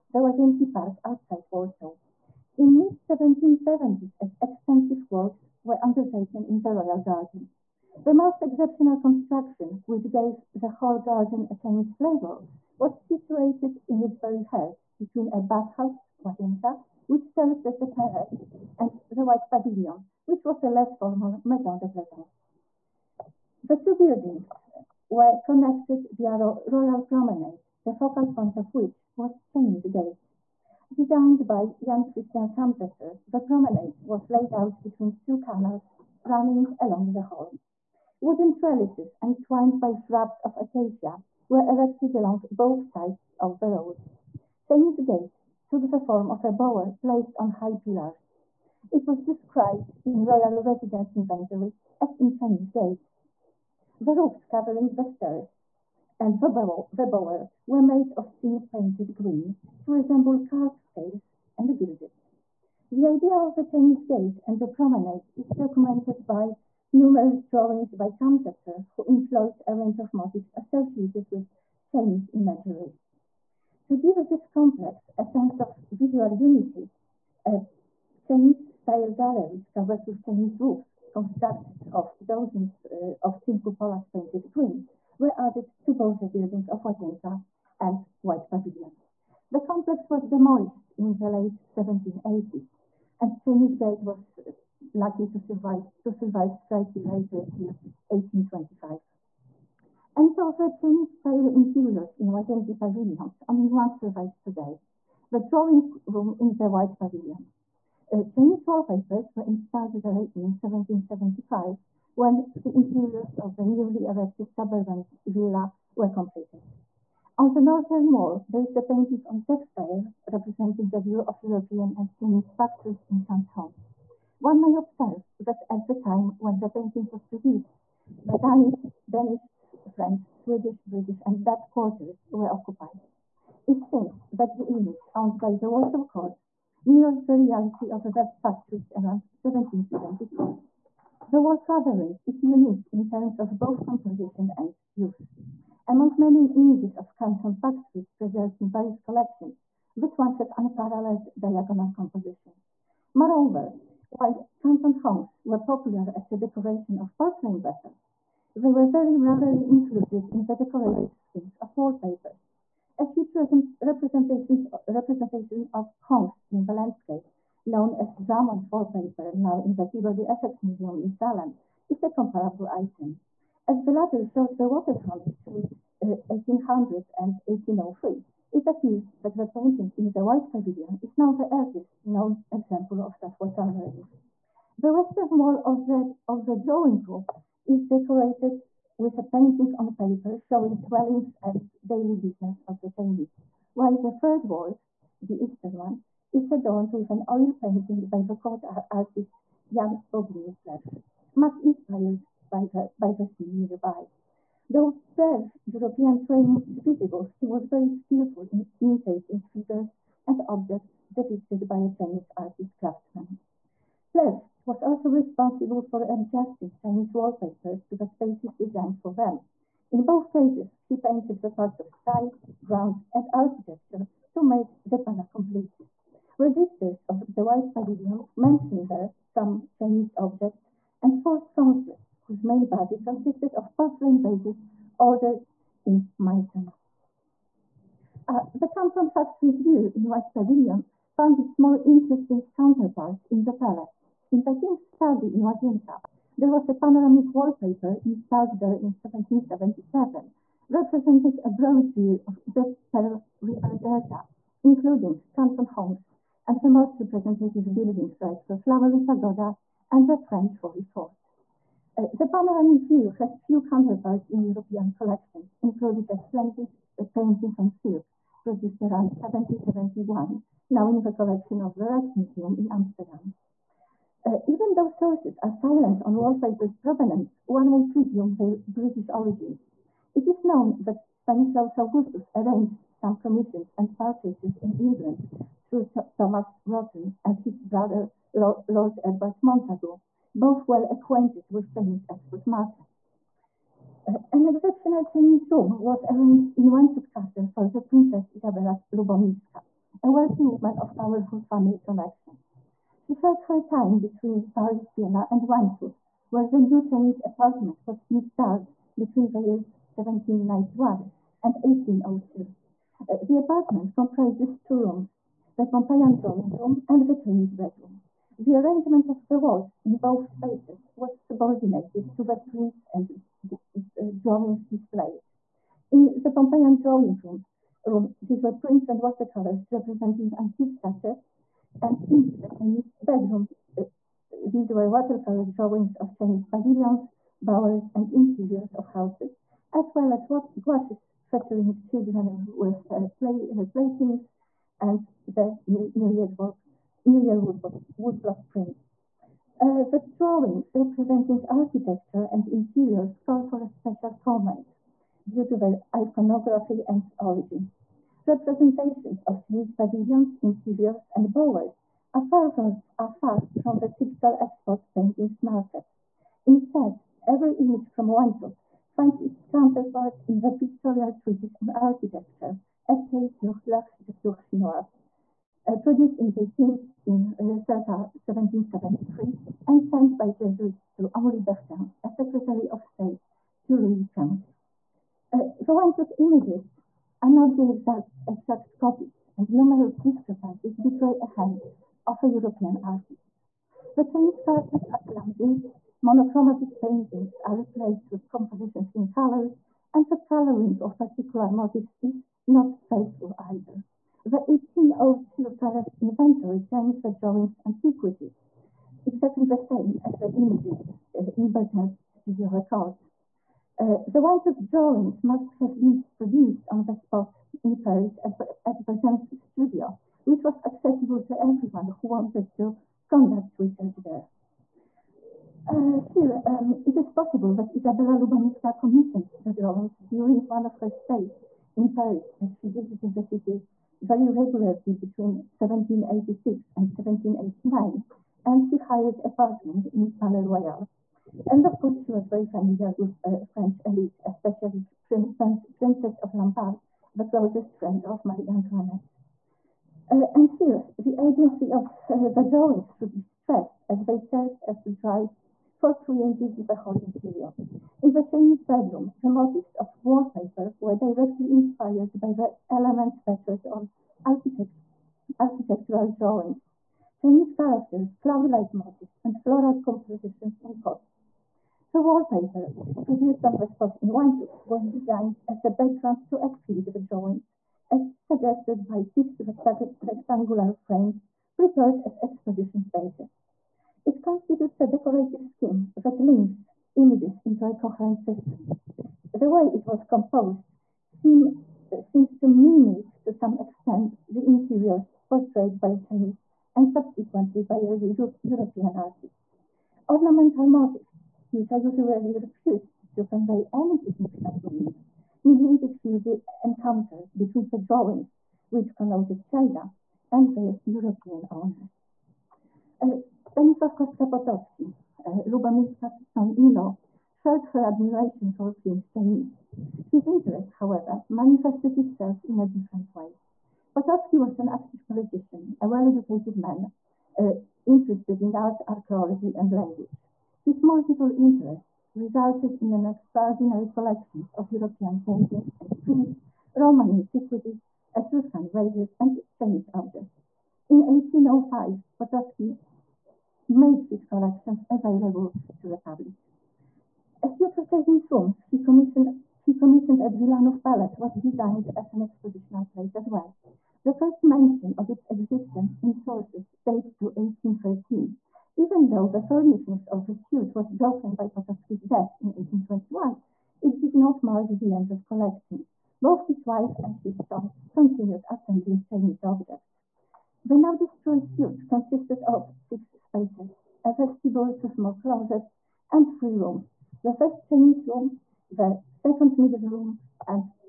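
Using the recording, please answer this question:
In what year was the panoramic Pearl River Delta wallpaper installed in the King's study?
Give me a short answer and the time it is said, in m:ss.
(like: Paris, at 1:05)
1777, at 4:08.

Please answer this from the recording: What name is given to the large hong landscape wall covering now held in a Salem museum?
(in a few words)
Drummond wallpaper.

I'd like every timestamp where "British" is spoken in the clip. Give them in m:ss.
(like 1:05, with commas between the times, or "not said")
2:10, 4:38.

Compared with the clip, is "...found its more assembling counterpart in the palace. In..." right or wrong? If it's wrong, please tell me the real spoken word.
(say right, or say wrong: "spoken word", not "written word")
wrong: "interesting", not "assembling".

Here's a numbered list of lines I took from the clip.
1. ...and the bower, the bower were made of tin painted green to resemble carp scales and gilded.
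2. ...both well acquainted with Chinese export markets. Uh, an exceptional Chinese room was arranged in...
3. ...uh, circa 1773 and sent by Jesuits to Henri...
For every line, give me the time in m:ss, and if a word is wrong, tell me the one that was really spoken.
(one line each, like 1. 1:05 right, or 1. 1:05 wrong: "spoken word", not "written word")
1. 0:56 right
2. 4:50 right
3. 6:17 right.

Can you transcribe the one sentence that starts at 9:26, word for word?
Both his wife and his son continued assembling Chinese objects.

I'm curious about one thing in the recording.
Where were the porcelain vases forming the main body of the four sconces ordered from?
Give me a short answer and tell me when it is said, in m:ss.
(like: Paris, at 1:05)
Meissen, at 3:56.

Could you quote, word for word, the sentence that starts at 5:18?
The arrangement of the walls in both spaces was subordinated to the prints and uh, drawings displayed.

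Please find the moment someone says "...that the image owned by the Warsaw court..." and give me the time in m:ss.
2:14.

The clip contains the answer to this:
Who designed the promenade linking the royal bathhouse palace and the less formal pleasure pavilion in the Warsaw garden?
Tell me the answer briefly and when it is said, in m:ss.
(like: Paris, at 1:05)
Jan Christian Kamsetzer, at 0:31.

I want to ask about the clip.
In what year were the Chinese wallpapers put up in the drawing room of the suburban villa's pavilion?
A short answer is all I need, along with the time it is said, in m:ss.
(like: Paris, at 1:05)
1775, at 1:50.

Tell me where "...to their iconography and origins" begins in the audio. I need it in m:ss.
5:55.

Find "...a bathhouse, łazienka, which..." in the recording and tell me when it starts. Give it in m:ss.
0:15.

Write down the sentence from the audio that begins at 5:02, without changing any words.
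She shared her time between Paris, Vienna, and Łańcut, where the new Chinese apartment was installed between the years 1791 and 1802.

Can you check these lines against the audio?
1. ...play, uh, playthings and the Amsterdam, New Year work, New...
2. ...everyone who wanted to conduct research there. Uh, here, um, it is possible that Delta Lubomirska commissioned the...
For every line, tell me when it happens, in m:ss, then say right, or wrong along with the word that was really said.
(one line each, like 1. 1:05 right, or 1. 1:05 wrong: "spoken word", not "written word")
1. 5:43 wrong: "New", not "Amsterdam"
2. 7:01 wrong: "Isabella", not "Delta".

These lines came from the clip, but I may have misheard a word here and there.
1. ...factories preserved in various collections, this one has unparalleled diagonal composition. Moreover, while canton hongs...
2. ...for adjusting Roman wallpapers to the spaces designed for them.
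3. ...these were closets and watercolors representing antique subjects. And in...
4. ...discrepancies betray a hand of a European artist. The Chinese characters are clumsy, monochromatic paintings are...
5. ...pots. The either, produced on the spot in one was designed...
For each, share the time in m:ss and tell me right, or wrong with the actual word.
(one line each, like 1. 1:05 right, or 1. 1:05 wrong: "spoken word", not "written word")
1. 2:27 right
2. 3:35 wrong: "Chinese", not "Roman"
3. 5:28 wrong: "prints", not "closets"
4. 6:29 right
5. 7:50 wrong: "wallpaper", not "either".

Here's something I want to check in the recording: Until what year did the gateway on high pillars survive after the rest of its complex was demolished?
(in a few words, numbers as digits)
1825.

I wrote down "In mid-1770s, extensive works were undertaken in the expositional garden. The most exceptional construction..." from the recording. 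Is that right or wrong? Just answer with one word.
wrong.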